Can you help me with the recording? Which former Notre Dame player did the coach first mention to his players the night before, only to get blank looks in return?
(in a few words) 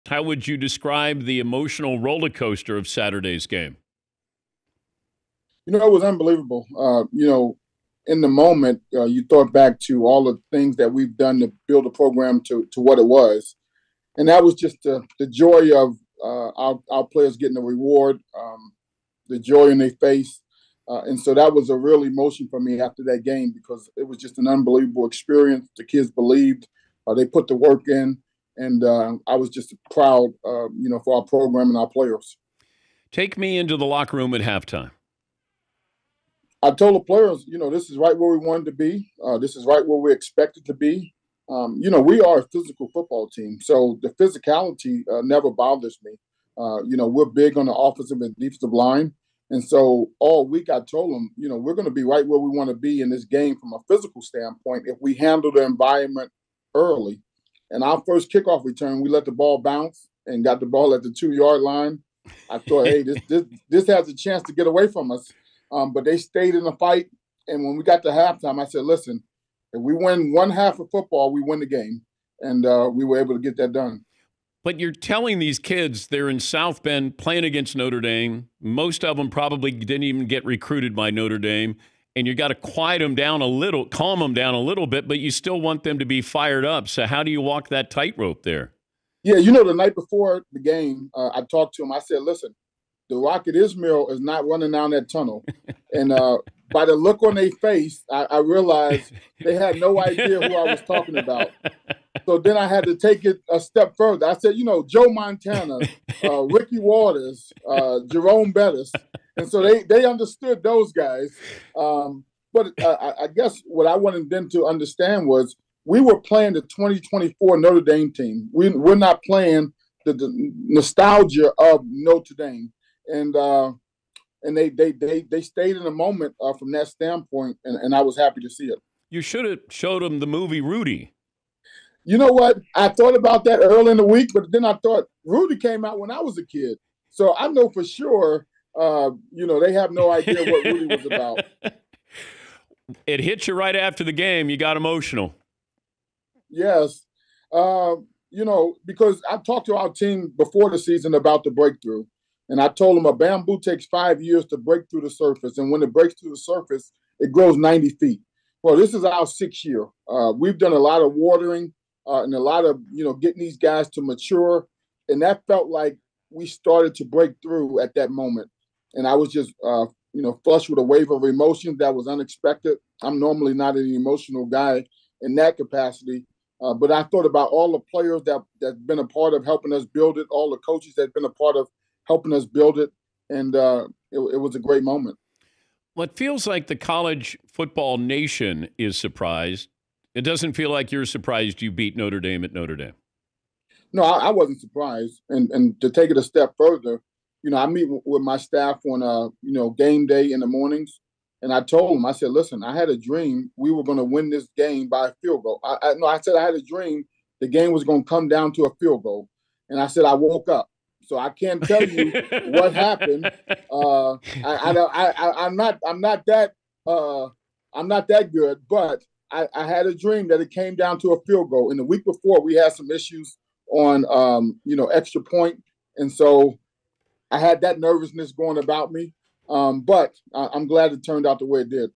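Rocket Ismail.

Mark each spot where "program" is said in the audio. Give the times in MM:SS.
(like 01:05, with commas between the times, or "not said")
00:11, 00:31.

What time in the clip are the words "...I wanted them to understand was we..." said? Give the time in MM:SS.
01:53.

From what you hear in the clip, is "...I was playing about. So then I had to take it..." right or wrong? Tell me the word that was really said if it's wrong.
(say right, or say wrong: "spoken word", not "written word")
wrong: "talking", not "playing".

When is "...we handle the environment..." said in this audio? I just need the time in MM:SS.
00:55.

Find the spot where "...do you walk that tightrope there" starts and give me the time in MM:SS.
01:27.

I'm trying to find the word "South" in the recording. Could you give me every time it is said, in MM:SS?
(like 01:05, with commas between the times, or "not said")
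01:16.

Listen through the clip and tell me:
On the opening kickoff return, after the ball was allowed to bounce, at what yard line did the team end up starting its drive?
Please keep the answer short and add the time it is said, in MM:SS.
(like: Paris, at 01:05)
2 yard line, at 01:01.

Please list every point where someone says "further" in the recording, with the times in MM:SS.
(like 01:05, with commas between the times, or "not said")
01:43, 03:16.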